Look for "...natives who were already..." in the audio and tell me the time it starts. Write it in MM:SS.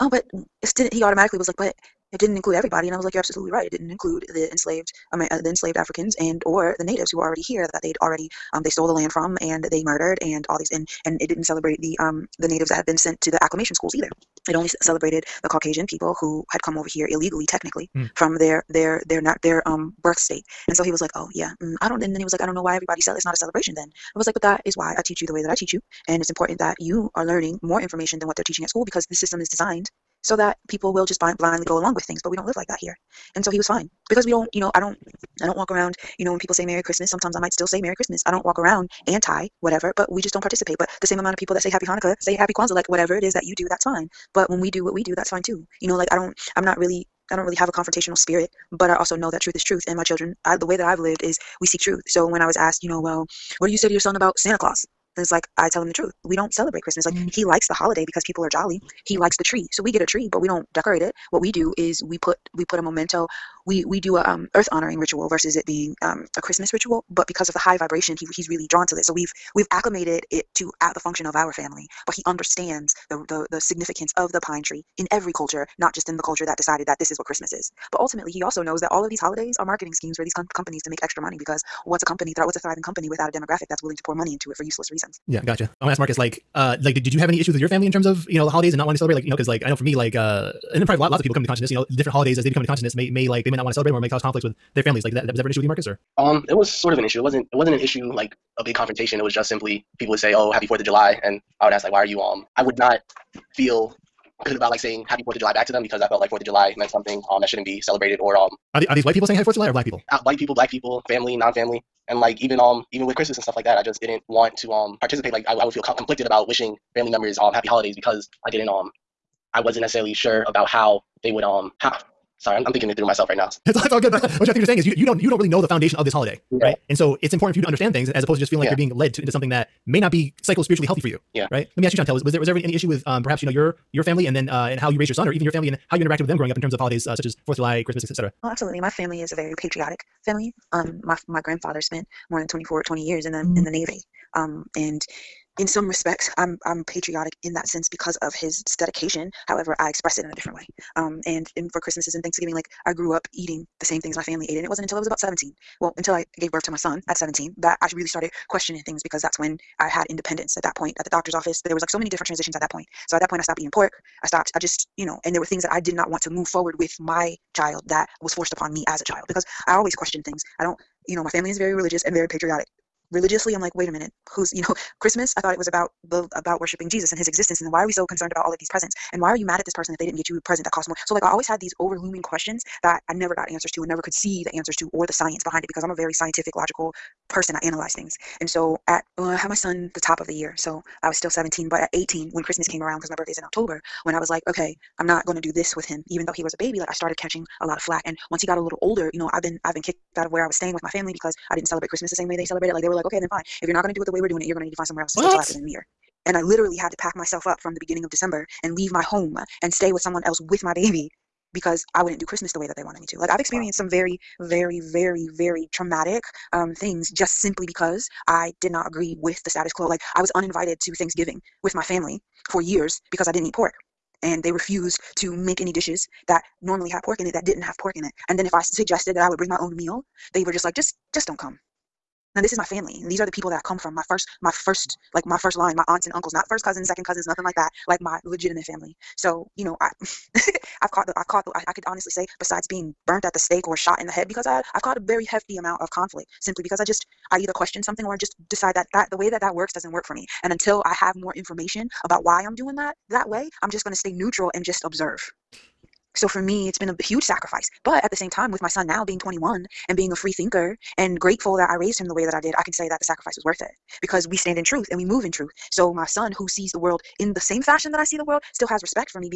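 00:06.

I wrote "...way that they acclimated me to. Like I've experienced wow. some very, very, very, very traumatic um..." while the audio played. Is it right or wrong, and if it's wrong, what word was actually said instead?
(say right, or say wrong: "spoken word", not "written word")
wrong: "wanted", not "acclimated".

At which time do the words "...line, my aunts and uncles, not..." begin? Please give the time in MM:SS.
03:55.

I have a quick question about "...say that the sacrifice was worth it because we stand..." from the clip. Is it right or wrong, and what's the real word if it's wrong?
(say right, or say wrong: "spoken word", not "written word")
right.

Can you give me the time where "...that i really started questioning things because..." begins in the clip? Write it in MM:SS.
02:37.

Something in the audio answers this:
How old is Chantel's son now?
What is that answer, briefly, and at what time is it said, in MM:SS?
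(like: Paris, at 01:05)
21, at 04:19.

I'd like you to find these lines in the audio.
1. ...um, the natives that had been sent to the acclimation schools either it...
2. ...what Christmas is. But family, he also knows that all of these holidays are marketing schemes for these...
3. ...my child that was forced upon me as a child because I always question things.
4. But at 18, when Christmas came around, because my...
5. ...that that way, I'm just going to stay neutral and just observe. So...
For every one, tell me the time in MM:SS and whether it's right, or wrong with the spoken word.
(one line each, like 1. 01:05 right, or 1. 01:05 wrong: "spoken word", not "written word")
1. 00:11 right
2. 01:17 wrong: "ultimately", not "family"
3. 02:46 right
4. 03:11 right
5. 04:12 right.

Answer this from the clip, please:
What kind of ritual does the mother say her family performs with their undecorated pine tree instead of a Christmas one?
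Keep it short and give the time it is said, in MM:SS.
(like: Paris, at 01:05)
Earth honoring ritual, at 01:04.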